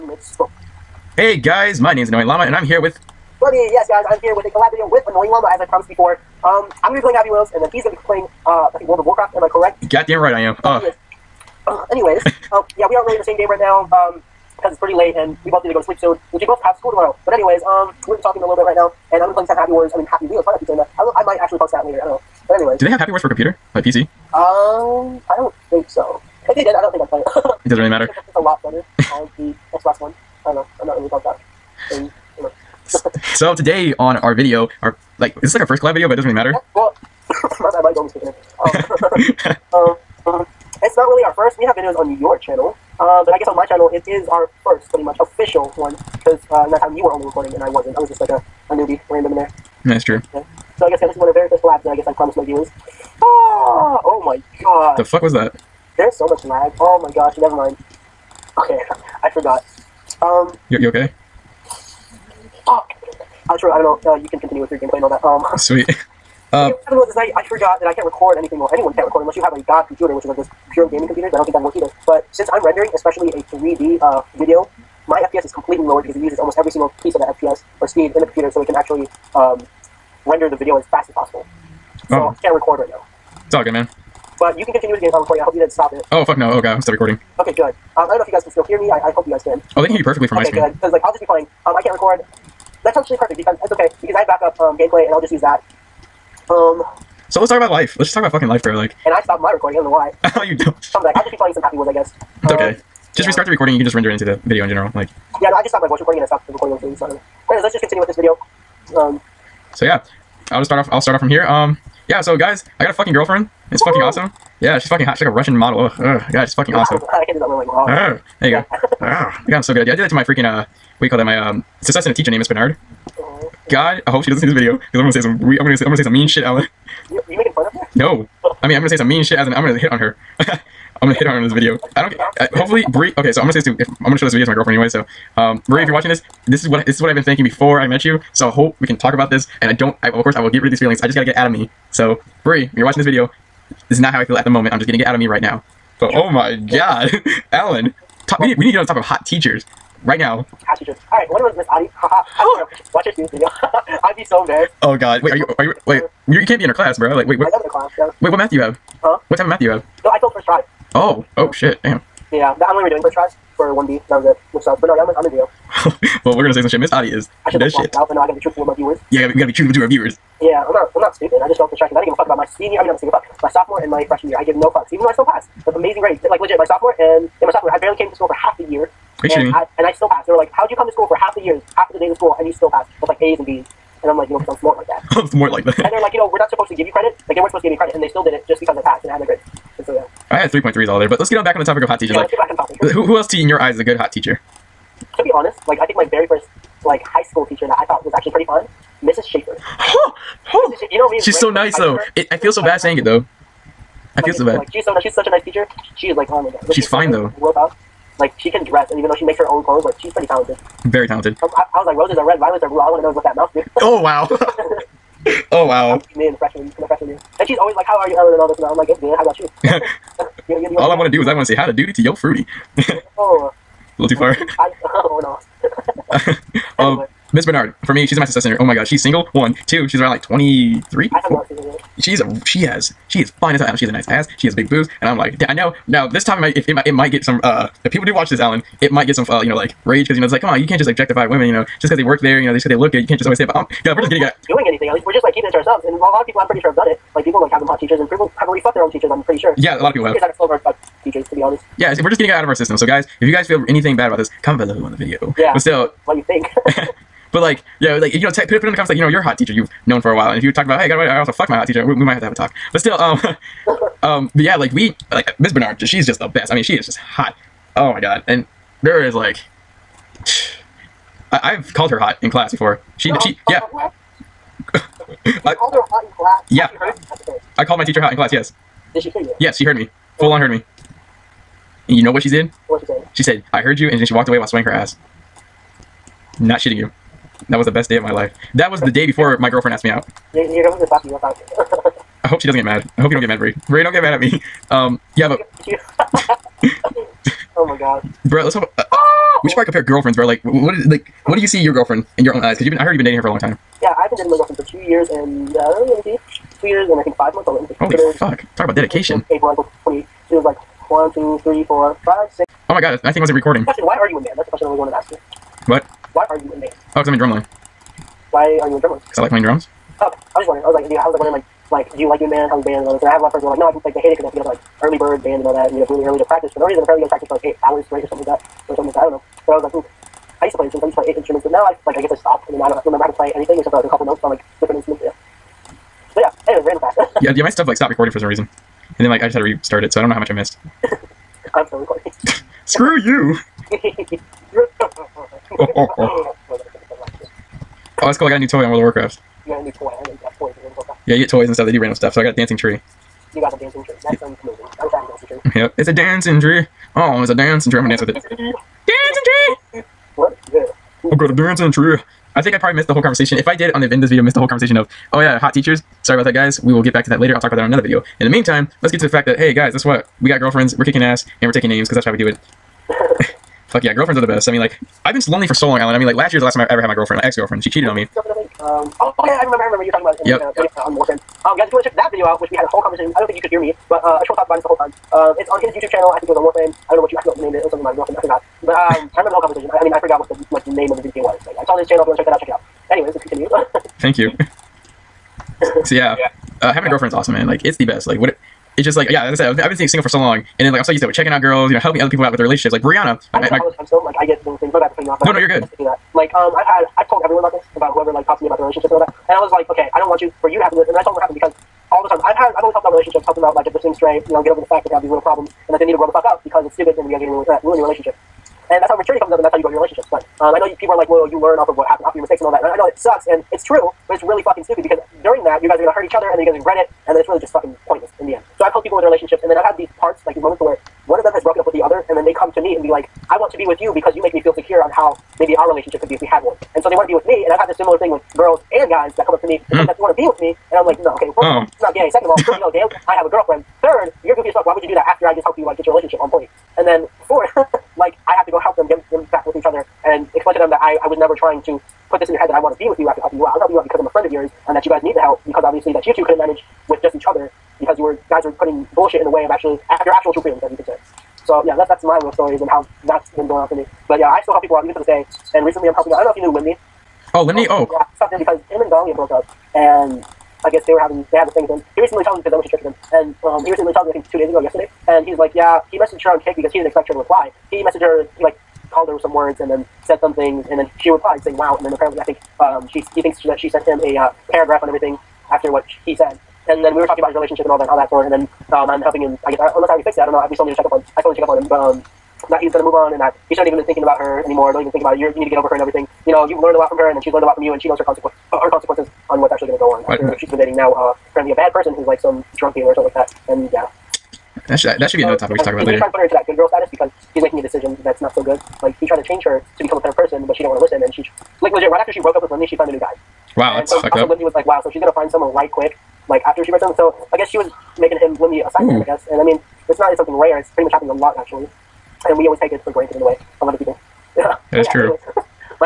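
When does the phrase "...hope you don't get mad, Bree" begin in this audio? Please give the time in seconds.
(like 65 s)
293 s.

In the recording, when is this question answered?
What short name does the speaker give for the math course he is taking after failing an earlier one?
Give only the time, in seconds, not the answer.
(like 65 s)
165 s.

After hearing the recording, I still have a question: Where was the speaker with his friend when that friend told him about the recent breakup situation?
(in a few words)
Church.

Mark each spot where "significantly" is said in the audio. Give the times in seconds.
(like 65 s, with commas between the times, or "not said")
not said.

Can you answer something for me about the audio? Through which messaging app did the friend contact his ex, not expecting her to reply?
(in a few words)
Kik.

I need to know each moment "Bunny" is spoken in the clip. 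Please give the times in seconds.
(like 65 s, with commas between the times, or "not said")
3 s.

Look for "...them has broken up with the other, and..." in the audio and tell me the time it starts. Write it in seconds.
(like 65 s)
431 s.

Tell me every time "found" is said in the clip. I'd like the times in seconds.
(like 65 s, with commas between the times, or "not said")
512 s.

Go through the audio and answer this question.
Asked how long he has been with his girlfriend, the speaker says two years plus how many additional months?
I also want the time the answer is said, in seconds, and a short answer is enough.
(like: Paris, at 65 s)
5 months, at 307 s.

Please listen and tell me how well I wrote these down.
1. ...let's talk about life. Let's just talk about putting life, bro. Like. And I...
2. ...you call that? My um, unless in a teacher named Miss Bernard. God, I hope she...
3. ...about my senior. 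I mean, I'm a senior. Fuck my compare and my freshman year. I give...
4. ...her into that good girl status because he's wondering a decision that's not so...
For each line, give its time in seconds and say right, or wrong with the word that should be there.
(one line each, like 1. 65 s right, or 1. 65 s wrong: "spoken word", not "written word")
1. 97 s wrong: "fucking", not "putting"
2. 121 s wrong: "success", not "unless"
3. 172 s wrong: "sophomore", not "compare"
4. 506 s wrong: "making", not "wondering".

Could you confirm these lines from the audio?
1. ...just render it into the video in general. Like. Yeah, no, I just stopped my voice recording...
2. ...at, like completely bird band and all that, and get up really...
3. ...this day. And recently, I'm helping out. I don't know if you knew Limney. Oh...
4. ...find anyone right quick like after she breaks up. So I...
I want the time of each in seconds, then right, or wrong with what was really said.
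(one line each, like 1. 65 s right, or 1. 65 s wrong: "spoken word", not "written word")
1. 103 s right
2. 324 s wrong: "early", not "completely"
3. 464 s right
4. 515 s wrong: "someone", not "anyone".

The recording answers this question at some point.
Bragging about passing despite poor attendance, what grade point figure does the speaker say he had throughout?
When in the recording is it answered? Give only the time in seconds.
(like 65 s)
190 s.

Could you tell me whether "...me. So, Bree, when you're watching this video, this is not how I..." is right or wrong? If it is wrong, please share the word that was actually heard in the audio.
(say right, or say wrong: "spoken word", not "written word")
right.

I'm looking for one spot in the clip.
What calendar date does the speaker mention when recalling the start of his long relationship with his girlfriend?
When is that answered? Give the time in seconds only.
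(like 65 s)
309 s.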